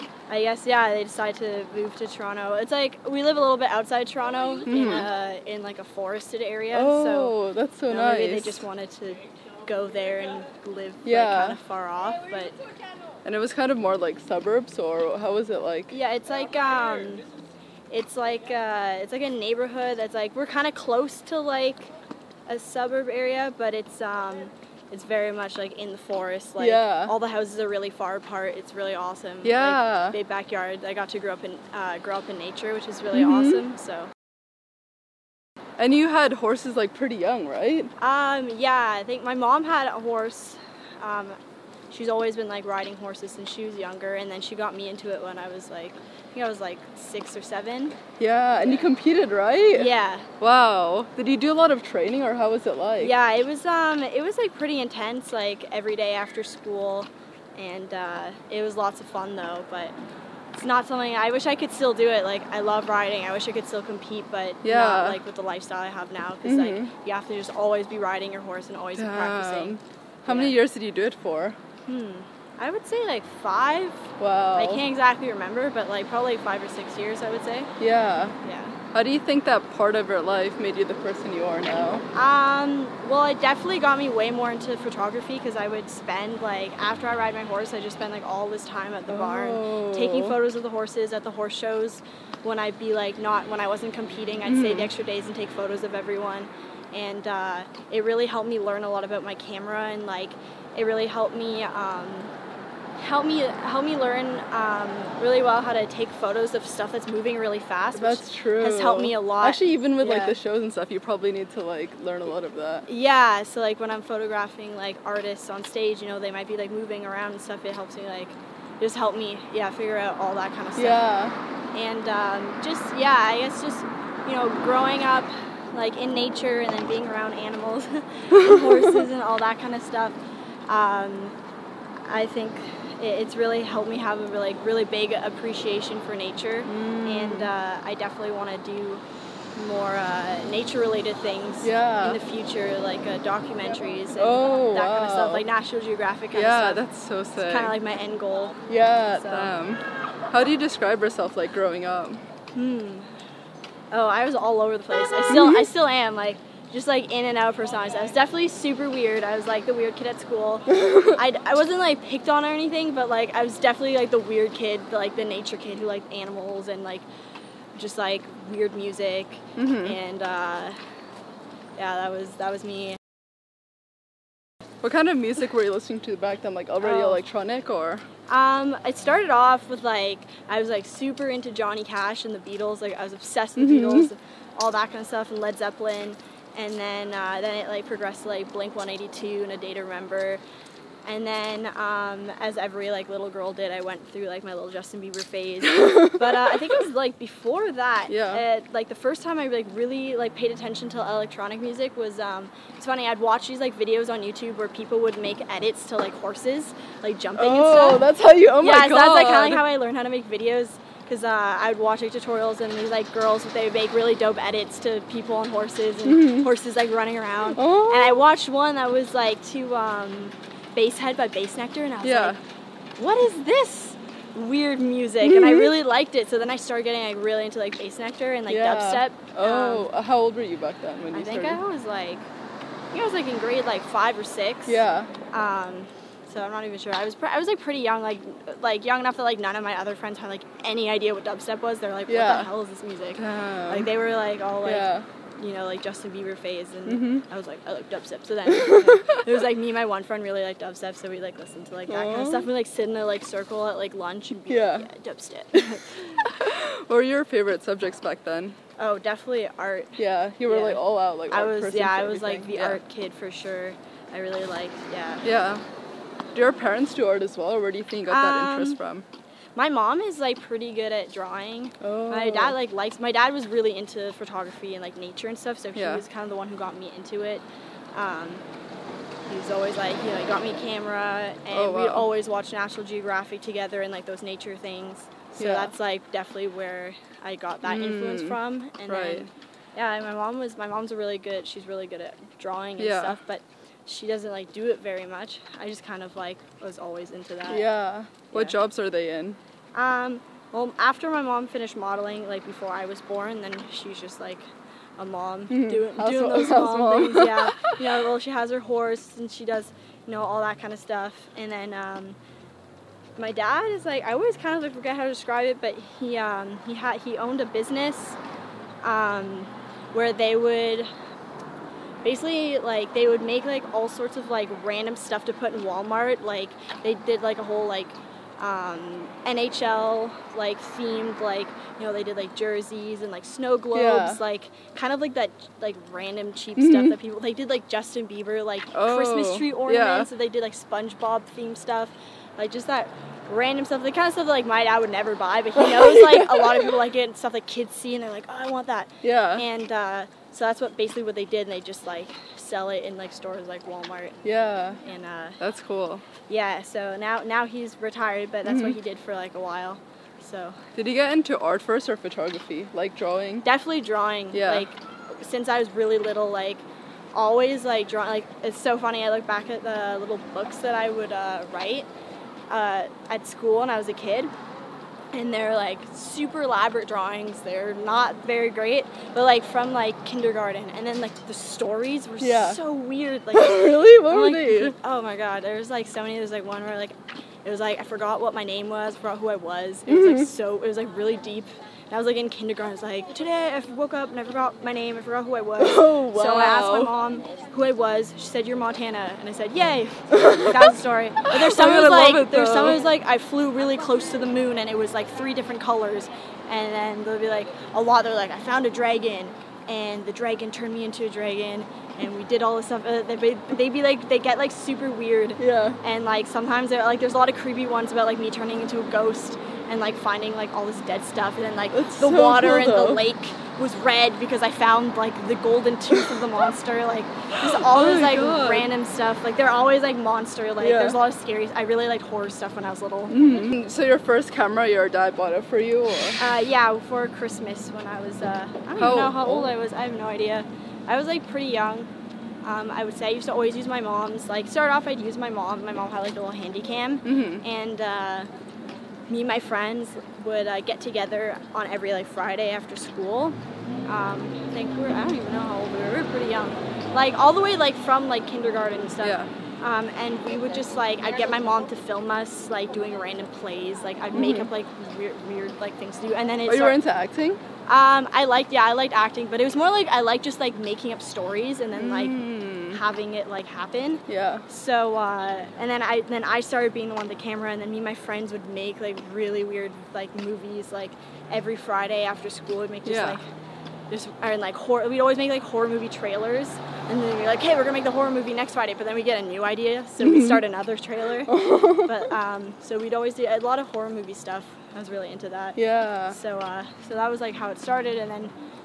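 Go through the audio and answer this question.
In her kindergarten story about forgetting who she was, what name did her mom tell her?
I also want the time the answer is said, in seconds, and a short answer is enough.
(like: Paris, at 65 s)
Montana, at 398 s.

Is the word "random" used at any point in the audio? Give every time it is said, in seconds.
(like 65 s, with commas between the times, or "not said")
324 s, 335 s, 343 s, 428 s, 462 s.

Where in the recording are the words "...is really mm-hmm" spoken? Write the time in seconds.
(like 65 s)
32 s.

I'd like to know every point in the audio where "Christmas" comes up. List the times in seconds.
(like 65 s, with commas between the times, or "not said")
338 s, 437 s.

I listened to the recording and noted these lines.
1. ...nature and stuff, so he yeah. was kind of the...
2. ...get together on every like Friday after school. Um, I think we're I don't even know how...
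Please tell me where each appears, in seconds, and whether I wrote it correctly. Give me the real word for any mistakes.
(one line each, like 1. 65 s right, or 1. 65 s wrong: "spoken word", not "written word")
1. 274 s right
2. 450 s right.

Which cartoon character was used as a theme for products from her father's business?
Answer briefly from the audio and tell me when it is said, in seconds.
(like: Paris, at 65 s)
SpongeBob, at 340 s.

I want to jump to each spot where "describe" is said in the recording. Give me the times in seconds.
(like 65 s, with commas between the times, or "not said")
150 s, 315 s.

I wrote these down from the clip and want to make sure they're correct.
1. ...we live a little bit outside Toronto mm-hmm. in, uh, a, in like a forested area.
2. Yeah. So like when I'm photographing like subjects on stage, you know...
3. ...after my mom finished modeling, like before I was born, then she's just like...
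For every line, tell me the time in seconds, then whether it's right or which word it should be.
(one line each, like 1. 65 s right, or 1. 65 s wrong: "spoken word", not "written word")
1. 3 s right
2. 112 s wrong: "artists", not "subjects"
3. 300 s right.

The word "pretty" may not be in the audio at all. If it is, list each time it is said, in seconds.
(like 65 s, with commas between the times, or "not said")
36 s, 54 s, 237 s, 270 s, 441 s, 456 s.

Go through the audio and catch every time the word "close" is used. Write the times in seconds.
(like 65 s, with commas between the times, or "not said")
20 s, 403 s.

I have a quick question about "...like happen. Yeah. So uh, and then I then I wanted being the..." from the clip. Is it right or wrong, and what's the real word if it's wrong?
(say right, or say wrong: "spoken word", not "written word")
wrong: "started", not "wanted".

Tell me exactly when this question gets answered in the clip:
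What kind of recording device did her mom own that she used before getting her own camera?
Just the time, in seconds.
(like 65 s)
446 s.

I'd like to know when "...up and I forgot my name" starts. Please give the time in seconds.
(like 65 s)
393 s.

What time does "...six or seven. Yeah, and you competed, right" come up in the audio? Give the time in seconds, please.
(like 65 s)
46 s.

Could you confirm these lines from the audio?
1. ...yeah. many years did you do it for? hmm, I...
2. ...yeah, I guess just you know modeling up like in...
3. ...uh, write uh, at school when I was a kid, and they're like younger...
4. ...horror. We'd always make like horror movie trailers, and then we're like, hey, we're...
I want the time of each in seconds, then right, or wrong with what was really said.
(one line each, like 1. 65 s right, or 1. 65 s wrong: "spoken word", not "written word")
1. 70 s right
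2. 122 s wrong: "growing", not "modeling"
3. 371 s wrong: "super", not "younger"
4. 484 s right.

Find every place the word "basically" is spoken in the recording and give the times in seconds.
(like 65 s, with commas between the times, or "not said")
322 s, 350 s.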